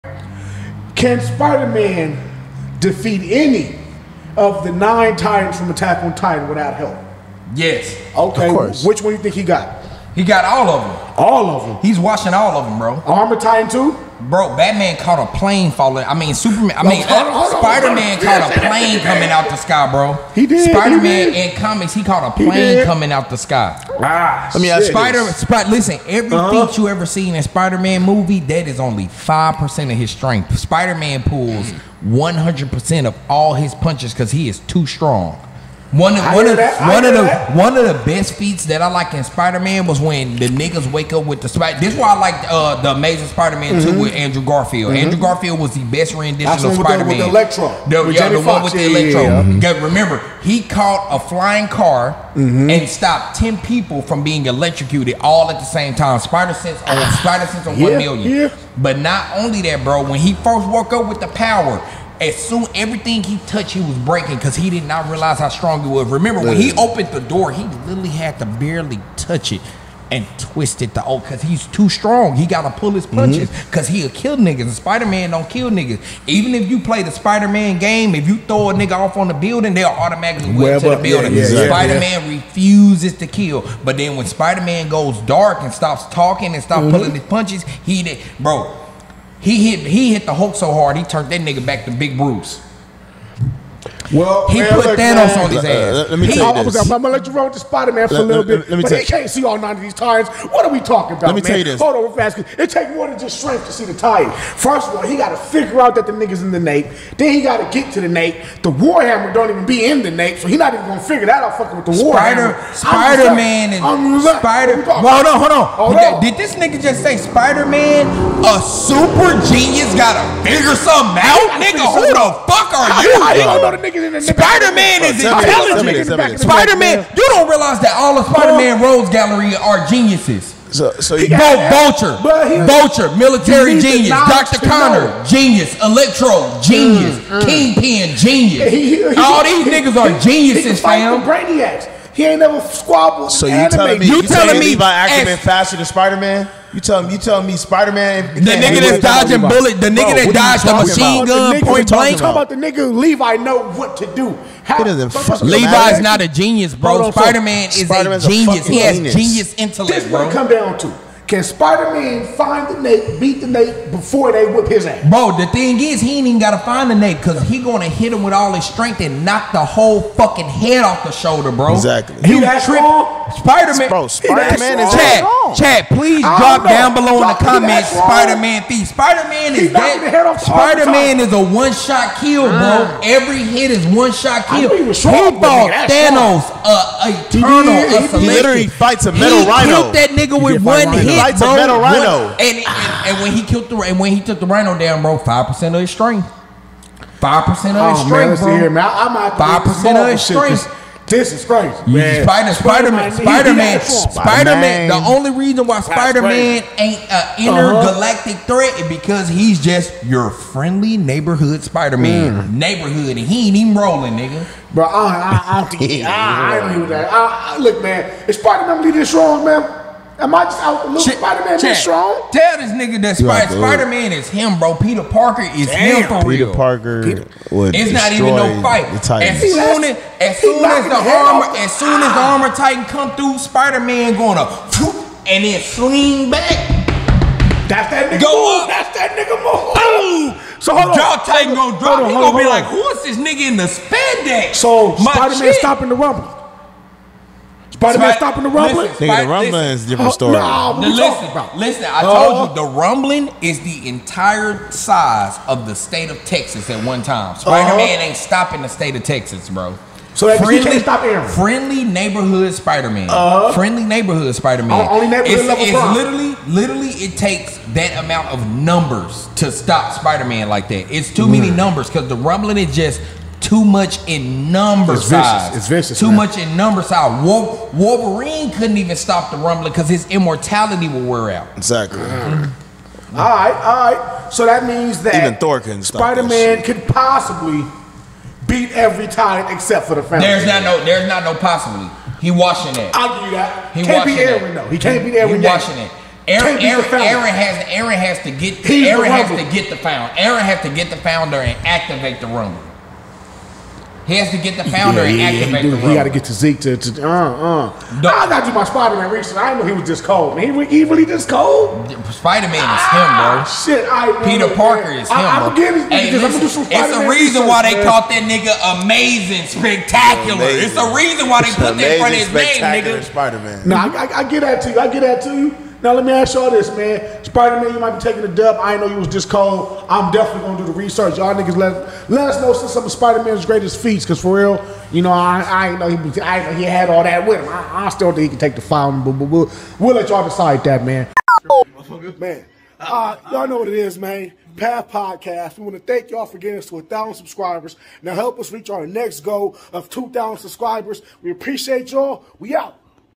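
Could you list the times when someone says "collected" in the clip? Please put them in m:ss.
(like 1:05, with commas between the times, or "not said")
not said.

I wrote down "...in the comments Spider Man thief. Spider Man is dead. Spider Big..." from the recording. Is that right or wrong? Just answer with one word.
wrong.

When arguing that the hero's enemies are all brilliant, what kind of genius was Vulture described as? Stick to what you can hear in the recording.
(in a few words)
Military genius.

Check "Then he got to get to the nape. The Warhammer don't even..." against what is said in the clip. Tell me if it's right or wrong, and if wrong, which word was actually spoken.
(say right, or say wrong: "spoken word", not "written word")
right.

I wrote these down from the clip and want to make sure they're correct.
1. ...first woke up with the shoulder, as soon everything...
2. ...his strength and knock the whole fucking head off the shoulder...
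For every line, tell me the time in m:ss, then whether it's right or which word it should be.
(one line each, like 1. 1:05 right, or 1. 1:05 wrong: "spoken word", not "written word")
1. 1:00 wrong: "power", not "shoulder"
2. 2:48 right.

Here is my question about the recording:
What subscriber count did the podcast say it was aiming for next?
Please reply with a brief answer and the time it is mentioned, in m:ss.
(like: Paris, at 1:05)
2000, at 5:49.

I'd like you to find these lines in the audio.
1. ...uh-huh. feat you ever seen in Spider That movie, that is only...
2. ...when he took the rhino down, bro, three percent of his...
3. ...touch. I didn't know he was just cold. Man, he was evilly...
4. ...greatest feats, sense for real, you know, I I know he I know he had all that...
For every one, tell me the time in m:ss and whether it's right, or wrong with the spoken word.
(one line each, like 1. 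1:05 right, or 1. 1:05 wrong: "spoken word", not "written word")
1. 0:26 wrong: "Man", not "That"
2. 3:13 wrong: "five", not "three"
3. 5:09 wrong: "research", not "touch"
4. 5:33 wrong: "cause", not "sense".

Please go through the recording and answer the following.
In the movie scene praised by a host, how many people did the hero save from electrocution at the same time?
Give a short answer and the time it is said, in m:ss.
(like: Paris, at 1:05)
10, at 0:53.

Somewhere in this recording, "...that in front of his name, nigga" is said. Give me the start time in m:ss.
5:21.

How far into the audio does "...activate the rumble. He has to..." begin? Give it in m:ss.
5:01.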